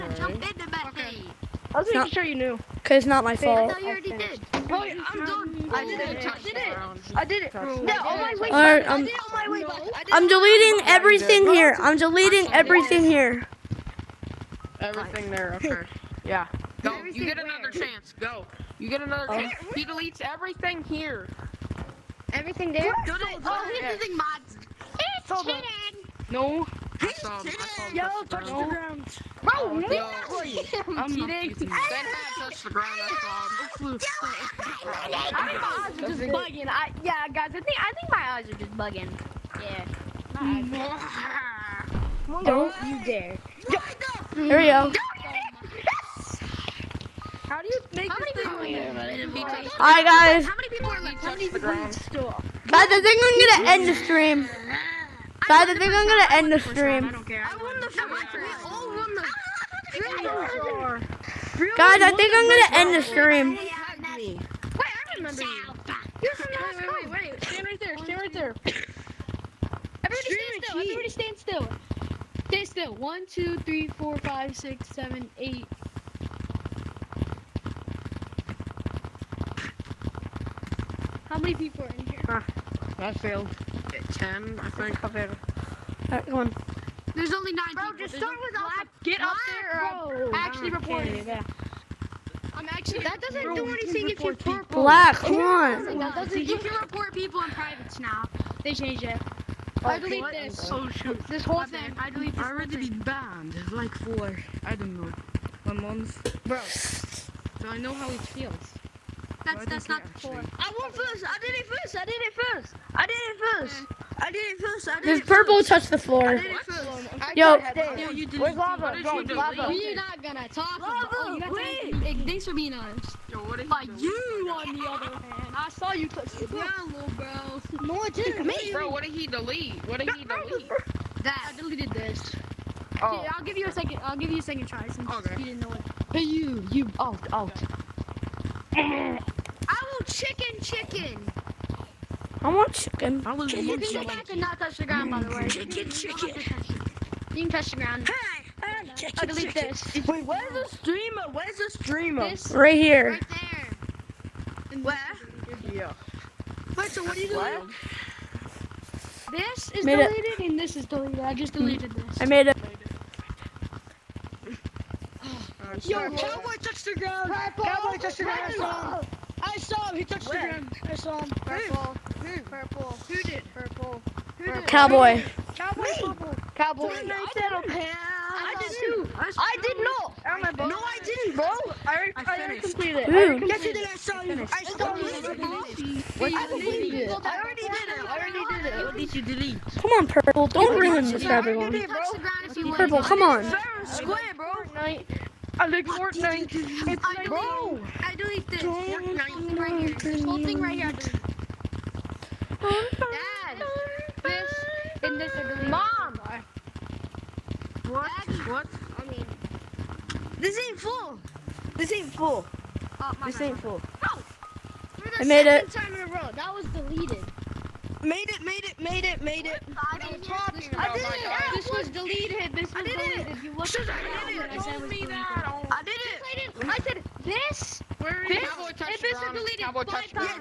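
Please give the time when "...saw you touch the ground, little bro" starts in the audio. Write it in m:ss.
2:05.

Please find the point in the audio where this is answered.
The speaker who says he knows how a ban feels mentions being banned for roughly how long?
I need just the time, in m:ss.
1:45.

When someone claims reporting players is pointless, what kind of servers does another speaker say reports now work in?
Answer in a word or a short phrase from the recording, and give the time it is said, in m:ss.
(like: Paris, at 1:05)
privates, at 1:37.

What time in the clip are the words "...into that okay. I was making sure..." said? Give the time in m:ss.
0:00.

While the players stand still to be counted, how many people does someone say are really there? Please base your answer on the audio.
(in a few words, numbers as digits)
9.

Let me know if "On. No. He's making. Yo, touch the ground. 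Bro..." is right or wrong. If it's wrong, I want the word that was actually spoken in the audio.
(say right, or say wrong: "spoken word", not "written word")
wrong: "cheating", not "making".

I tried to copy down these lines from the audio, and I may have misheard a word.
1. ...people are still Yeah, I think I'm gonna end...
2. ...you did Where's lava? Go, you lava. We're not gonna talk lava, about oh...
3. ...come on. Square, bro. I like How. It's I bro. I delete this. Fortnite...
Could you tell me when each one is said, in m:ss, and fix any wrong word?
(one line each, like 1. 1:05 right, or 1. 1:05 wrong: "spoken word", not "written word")
1. 0:51 wrong: "Guys", not "Yeah"
2. 1:58 right
3. 3:13 wrong: "Fortnite", not "How".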